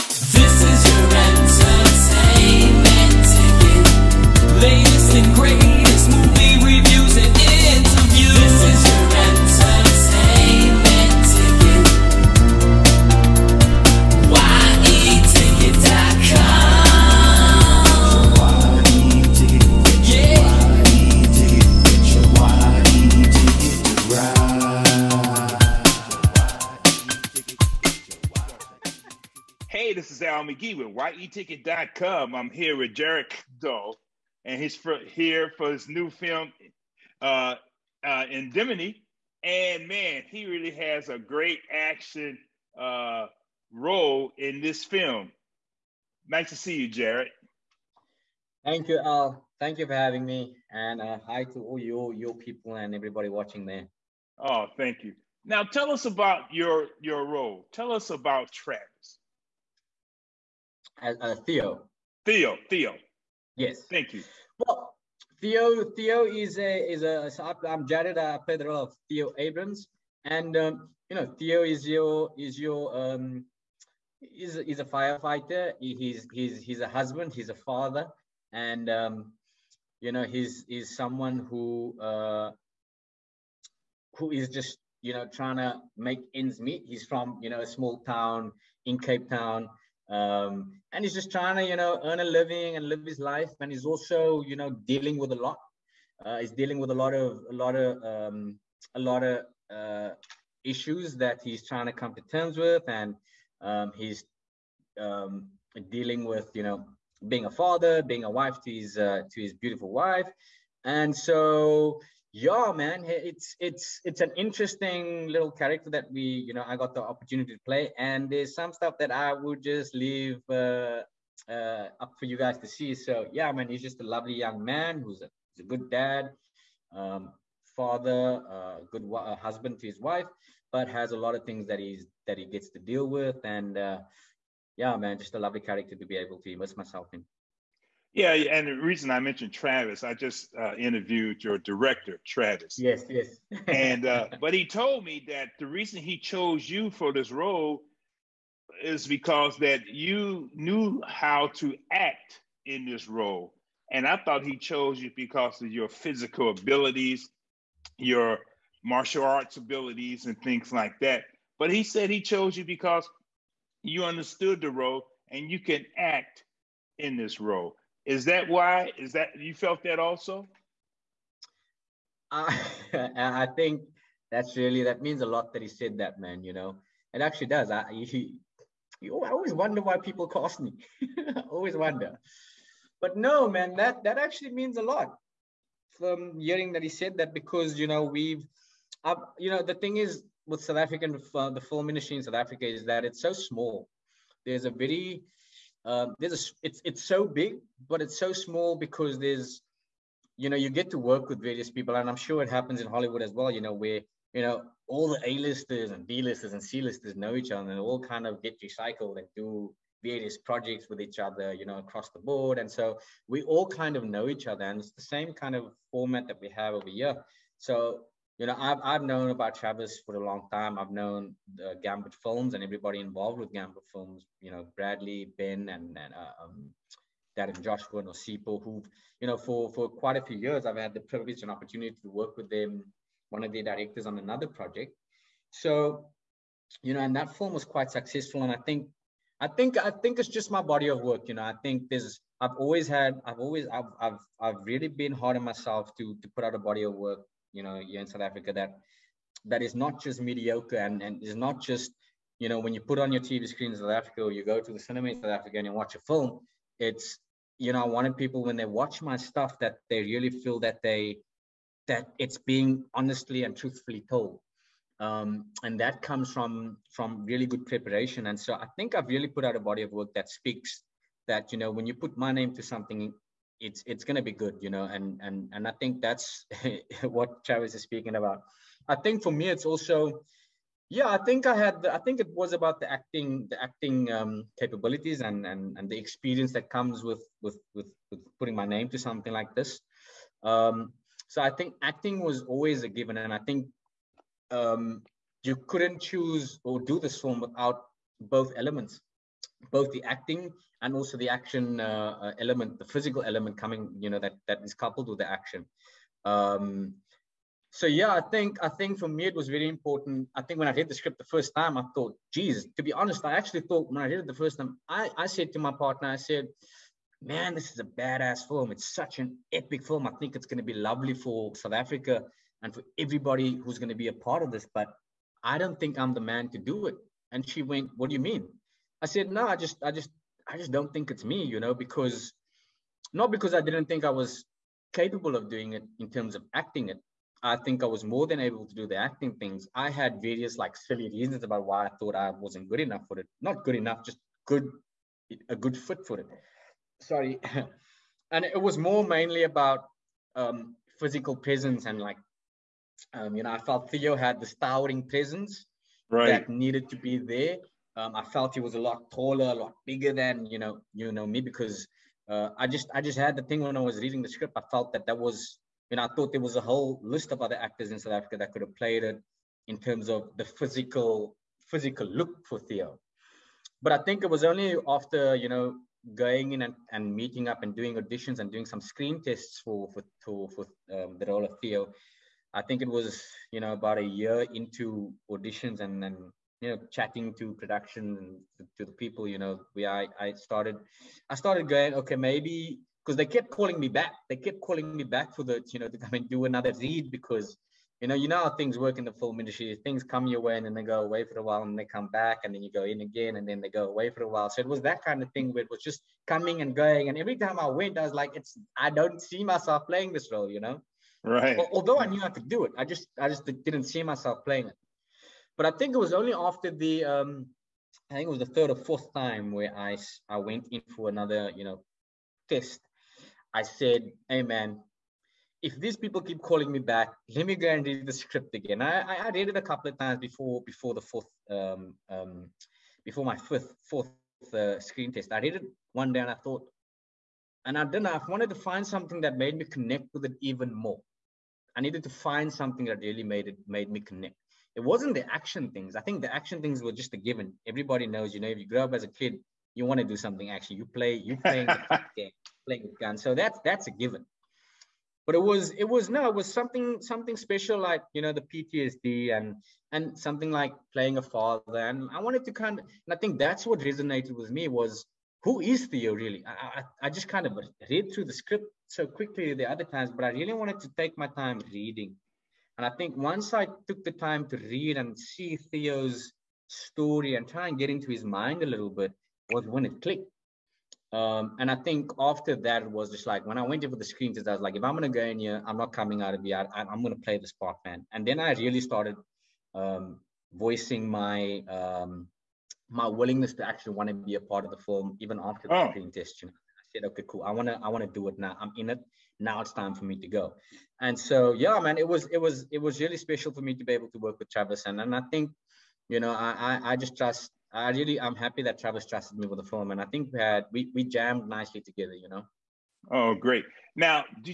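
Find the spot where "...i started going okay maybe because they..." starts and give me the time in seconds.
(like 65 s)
391 s.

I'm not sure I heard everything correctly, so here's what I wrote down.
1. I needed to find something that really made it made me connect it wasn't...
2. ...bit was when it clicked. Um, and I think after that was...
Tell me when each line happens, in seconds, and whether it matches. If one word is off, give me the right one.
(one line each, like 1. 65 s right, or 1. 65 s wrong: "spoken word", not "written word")
1. 441 s right
2. 478 s right.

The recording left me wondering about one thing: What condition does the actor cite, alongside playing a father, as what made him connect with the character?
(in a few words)
PTSD.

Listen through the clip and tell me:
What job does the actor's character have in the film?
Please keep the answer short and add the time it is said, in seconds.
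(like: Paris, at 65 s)
Firefighter, at 74 s.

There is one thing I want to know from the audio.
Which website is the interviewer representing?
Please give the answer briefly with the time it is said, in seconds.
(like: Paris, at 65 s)
YETicket.com, at 30 s.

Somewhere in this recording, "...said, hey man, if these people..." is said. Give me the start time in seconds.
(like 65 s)
423 s.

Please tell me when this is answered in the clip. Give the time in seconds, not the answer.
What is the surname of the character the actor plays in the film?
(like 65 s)
69 s.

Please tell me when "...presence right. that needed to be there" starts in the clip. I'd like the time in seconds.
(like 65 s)
355 s.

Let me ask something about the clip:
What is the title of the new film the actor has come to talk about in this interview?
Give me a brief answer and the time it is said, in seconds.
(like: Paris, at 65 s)
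Indemnity, at 38 s.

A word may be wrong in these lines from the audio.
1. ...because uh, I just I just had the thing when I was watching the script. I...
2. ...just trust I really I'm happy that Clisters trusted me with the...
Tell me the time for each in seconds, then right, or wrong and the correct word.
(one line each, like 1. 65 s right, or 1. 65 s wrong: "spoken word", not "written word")
1. 361 s wrong: "reading", not "watching"
2. 506 s wrong: "Travis", not "Clisters".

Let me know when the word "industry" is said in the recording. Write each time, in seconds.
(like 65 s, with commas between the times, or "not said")
191 s, 399 s.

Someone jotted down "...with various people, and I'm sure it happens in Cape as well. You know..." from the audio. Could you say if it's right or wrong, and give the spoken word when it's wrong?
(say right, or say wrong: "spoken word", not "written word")
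wrong: "Hollywood", not "Cape".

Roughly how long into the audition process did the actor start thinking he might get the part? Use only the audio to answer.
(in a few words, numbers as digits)
About a year.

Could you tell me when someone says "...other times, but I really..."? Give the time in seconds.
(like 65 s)
469 s.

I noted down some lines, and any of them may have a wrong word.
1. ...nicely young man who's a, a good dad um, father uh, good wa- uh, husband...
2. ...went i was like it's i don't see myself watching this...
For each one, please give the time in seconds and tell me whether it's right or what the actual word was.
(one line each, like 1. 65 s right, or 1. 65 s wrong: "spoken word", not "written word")
1. 124 s wrong: "lovely", not "nicely"
2. 407 s wrong: "playing", not "watching".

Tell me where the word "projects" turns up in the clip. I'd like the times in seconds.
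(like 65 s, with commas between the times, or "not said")
210 s, 234 s.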